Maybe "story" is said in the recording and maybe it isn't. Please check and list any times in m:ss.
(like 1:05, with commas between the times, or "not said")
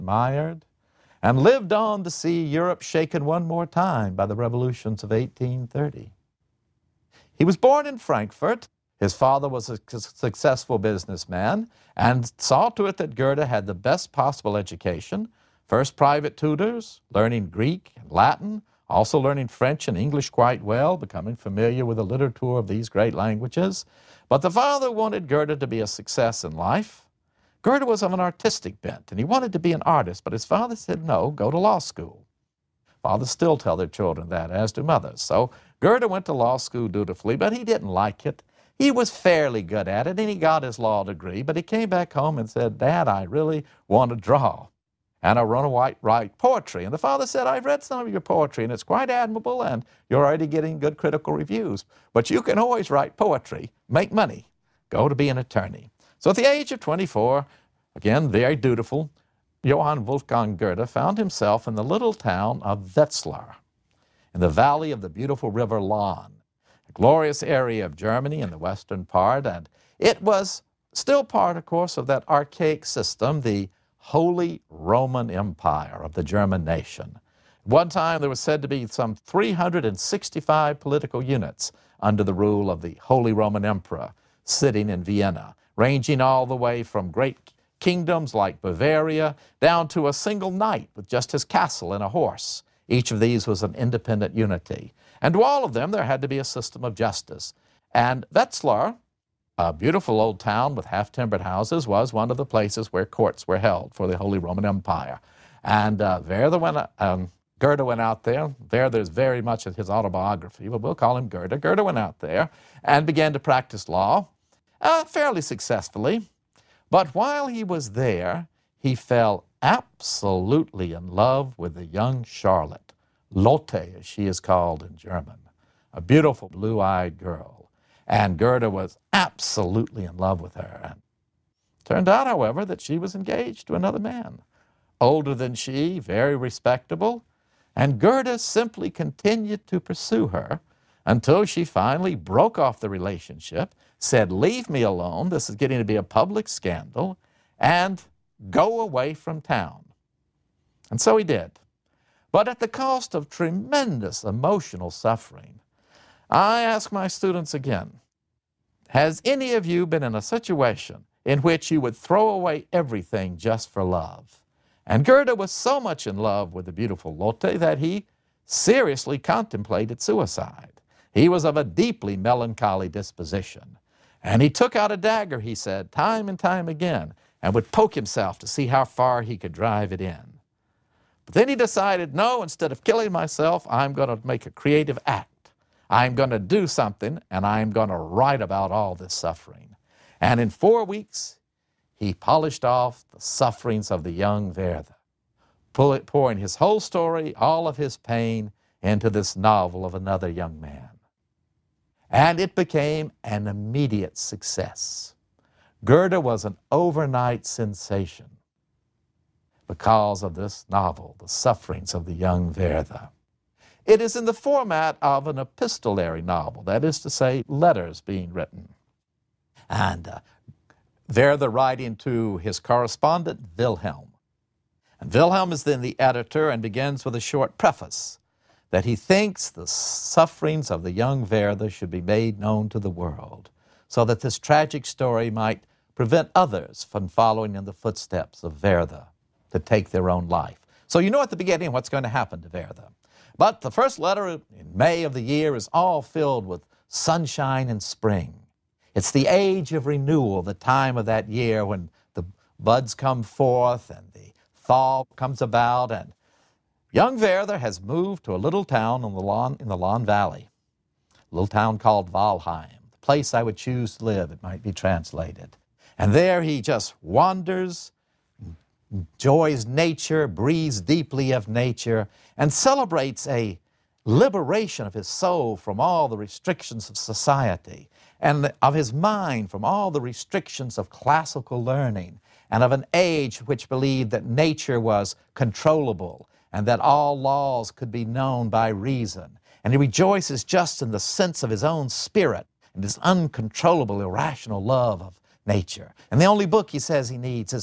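3:16, 3:54.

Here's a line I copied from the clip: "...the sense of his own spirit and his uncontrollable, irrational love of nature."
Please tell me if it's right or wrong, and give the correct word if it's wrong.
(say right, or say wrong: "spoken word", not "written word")
right.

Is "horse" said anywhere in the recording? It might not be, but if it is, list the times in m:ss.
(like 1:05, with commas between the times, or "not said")
1:32.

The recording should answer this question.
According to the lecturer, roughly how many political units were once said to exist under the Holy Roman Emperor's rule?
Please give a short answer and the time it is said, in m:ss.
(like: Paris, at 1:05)
365, at 1:19.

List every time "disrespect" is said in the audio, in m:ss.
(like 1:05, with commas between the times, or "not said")
not said.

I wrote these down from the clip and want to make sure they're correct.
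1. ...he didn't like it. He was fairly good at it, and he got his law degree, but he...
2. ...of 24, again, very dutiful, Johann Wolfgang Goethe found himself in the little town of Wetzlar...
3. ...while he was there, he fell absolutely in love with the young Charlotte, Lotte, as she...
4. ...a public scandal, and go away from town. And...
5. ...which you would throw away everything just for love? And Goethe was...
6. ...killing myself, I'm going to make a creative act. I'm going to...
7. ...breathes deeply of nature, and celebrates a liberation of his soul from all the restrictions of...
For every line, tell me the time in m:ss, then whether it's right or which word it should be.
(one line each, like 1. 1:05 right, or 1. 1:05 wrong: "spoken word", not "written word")
1. 0:37 right
2. 0:56 right
3. 1:57 right
4. 2:25 right
5. 2:41 right
6. 3:02 right
7. 4:30 right.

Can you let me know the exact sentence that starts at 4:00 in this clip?
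So you know at the beginning what's going to happen to Werther.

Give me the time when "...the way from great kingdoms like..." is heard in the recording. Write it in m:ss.
1:26.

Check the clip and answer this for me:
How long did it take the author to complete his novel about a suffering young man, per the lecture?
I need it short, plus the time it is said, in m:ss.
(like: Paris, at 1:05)
4 weeks, at 3:10.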